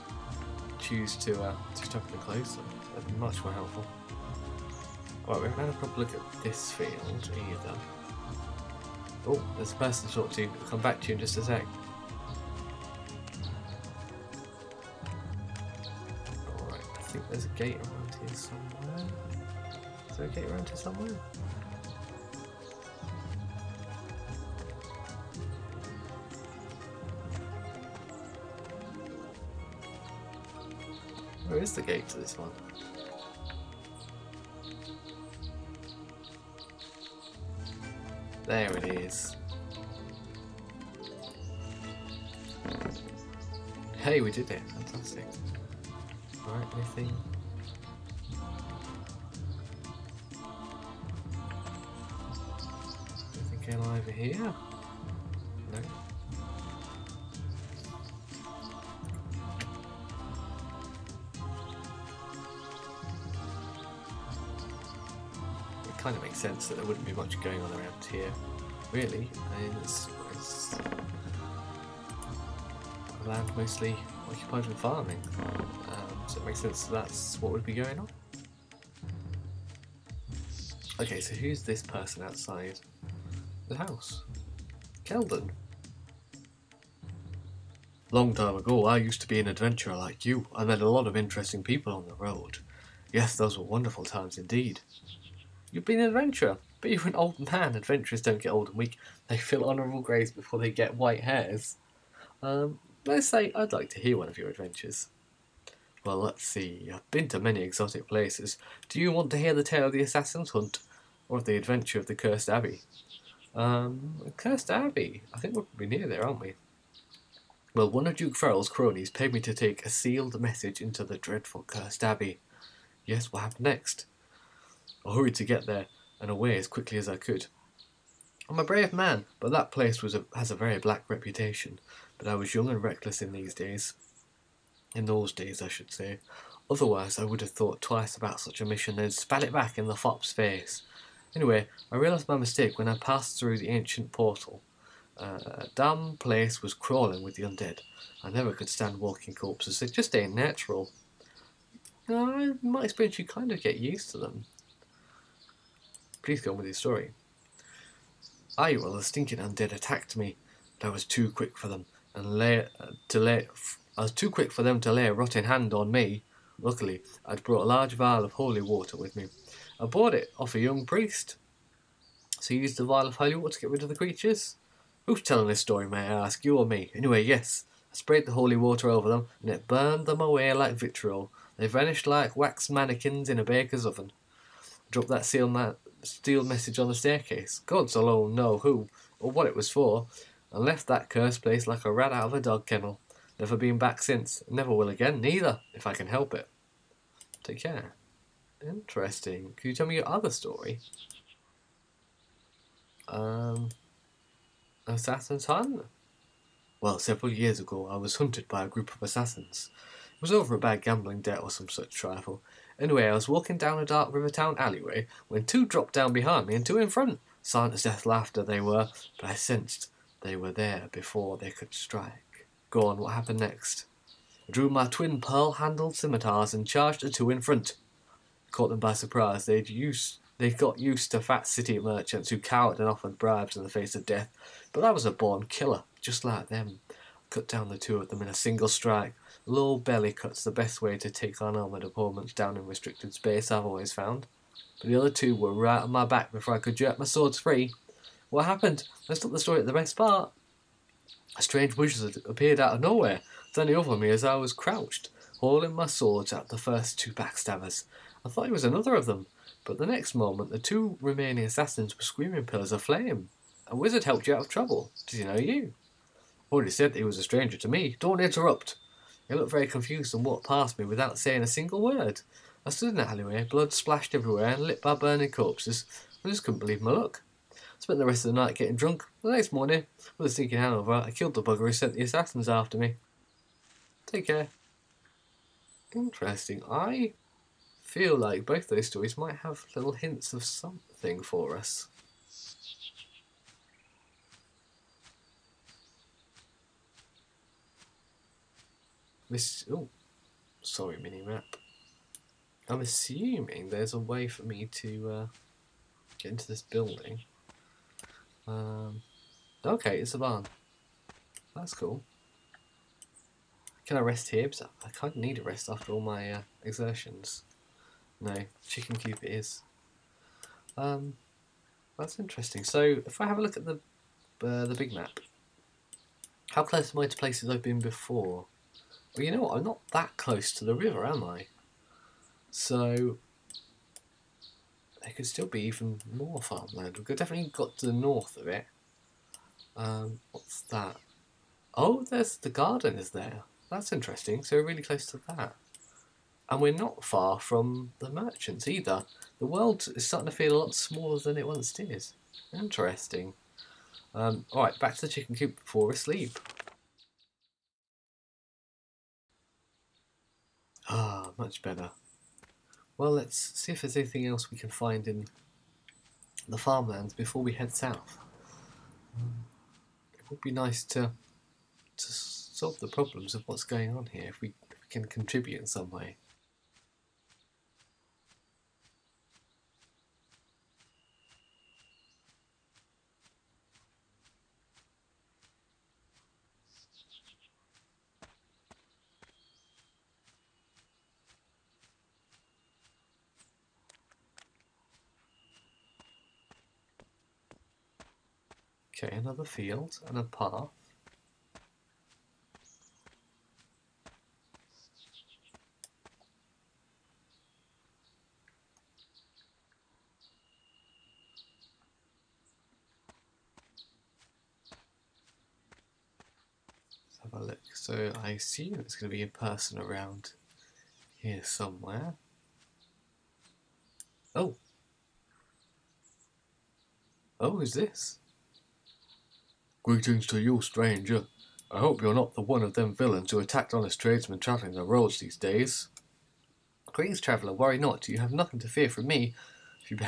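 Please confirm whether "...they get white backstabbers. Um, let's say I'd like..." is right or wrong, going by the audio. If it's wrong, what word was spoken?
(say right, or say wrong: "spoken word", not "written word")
wrong: "hairs", not "backstabbers".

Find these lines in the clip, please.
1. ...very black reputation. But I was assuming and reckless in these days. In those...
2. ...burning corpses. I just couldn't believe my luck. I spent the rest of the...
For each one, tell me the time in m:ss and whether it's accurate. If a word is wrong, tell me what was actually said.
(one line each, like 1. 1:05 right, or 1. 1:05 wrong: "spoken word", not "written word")
1. 2:10 wrong: "young", not "assuming"
2. 4:34 right.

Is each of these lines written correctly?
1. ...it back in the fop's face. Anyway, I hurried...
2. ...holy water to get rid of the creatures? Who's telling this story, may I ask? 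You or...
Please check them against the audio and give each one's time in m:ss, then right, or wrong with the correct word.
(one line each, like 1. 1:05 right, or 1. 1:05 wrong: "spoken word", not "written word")
1. 2:19 wrong: "realised", not "hurried"
2. 2:53 right.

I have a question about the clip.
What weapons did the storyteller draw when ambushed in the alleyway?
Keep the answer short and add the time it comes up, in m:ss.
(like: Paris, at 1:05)
Twin pearl-handled scimitars, at 3:44.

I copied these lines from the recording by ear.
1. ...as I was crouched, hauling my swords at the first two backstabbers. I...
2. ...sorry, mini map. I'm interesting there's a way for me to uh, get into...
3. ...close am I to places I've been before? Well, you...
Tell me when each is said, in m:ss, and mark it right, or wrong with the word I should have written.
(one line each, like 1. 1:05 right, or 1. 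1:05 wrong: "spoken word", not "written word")
1. 4:14 right
2. 5:00 wrong: "assuming", not "interesting"
3. 5:26 right.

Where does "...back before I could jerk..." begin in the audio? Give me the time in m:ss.
4:06.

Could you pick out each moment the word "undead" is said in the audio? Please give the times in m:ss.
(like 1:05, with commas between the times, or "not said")
2:27, 2:39.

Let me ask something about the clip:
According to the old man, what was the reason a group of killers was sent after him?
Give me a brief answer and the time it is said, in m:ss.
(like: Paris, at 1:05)
A bad gambling debt, at 3:30.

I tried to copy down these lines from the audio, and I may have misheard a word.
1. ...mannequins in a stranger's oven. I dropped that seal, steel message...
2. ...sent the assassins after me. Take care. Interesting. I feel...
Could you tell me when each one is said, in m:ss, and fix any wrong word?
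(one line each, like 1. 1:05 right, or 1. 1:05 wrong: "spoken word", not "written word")
1. 3:02 wrong: "baker", not "stranger"
2. 4:41 right.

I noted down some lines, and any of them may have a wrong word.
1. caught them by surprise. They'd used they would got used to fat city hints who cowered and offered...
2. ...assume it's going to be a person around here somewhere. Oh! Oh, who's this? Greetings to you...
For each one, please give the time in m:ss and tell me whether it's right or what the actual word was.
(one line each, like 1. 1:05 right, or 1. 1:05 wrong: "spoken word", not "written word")
1. 3:48 wrong: "merchants", not "hints"
2. 6:58 right.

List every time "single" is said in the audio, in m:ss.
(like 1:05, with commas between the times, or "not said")
3:58, 4:31.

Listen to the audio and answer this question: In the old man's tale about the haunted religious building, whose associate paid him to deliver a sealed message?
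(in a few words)
Duke Farrell.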